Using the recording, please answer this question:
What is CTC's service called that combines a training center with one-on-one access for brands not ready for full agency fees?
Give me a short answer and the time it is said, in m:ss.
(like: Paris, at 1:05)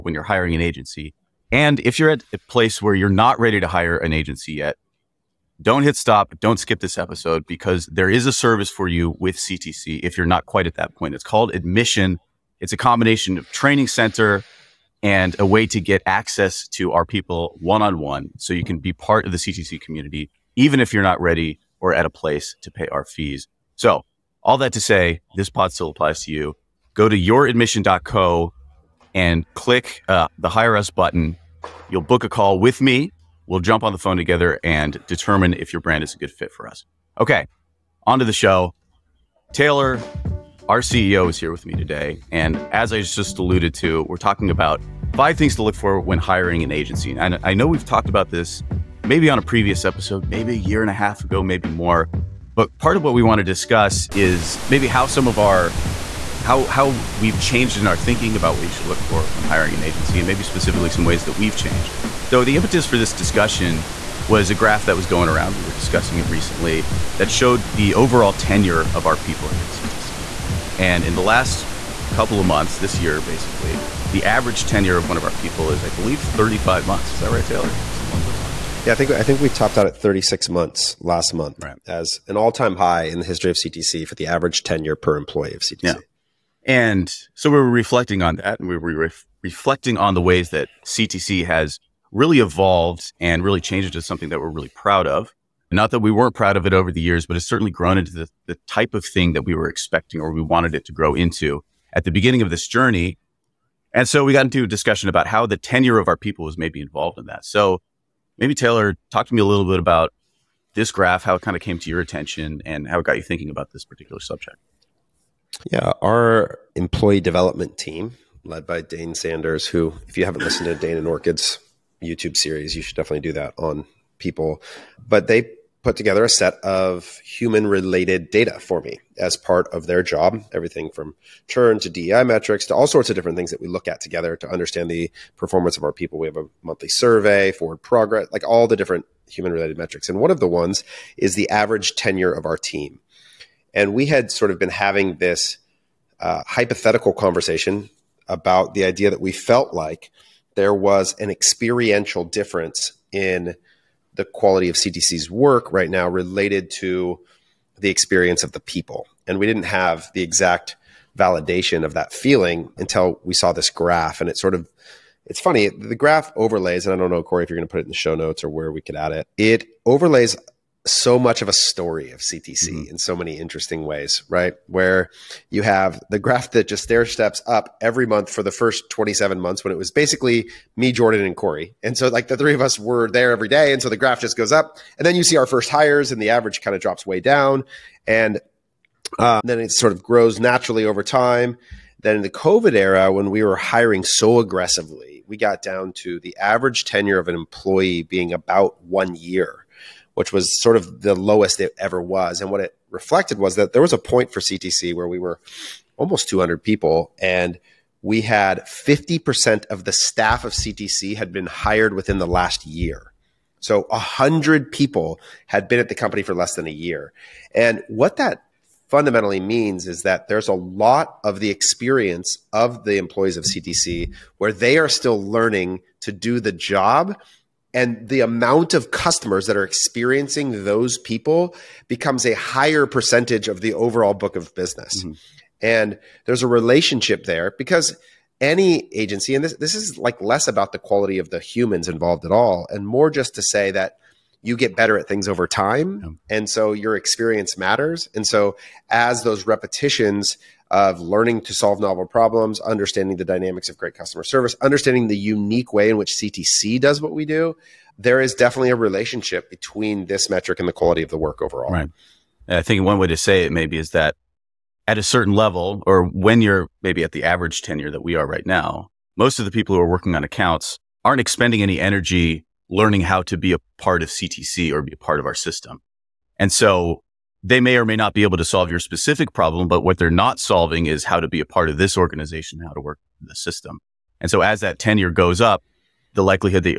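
Admission, at 0:11.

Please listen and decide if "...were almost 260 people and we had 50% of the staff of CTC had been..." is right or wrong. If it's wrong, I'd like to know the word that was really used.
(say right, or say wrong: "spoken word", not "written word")
wrong: "200", not "260".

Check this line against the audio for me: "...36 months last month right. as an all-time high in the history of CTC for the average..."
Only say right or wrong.
right.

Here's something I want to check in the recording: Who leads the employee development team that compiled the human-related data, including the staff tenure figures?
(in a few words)
Dane Sanders.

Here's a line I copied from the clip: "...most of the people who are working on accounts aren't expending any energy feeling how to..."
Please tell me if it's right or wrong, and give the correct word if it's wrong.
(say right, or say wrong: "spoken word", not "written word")
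wrong: "learning", not "feeling".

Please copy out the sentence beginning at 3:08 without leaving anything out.
And uh, then it sort of grows naturally over time.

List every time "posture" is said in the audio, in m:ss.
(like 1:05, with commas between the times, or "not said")
not said.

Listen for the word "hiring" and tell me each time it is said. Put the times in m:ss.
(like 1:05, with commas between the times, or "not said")
0:00, 0:46, 0:59, 3:13.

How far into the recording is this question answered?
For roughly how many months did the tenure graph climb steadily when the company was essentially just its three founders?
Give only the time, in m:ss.
2:58.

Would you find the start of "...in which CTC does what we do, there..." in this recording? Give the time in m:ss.
4:15.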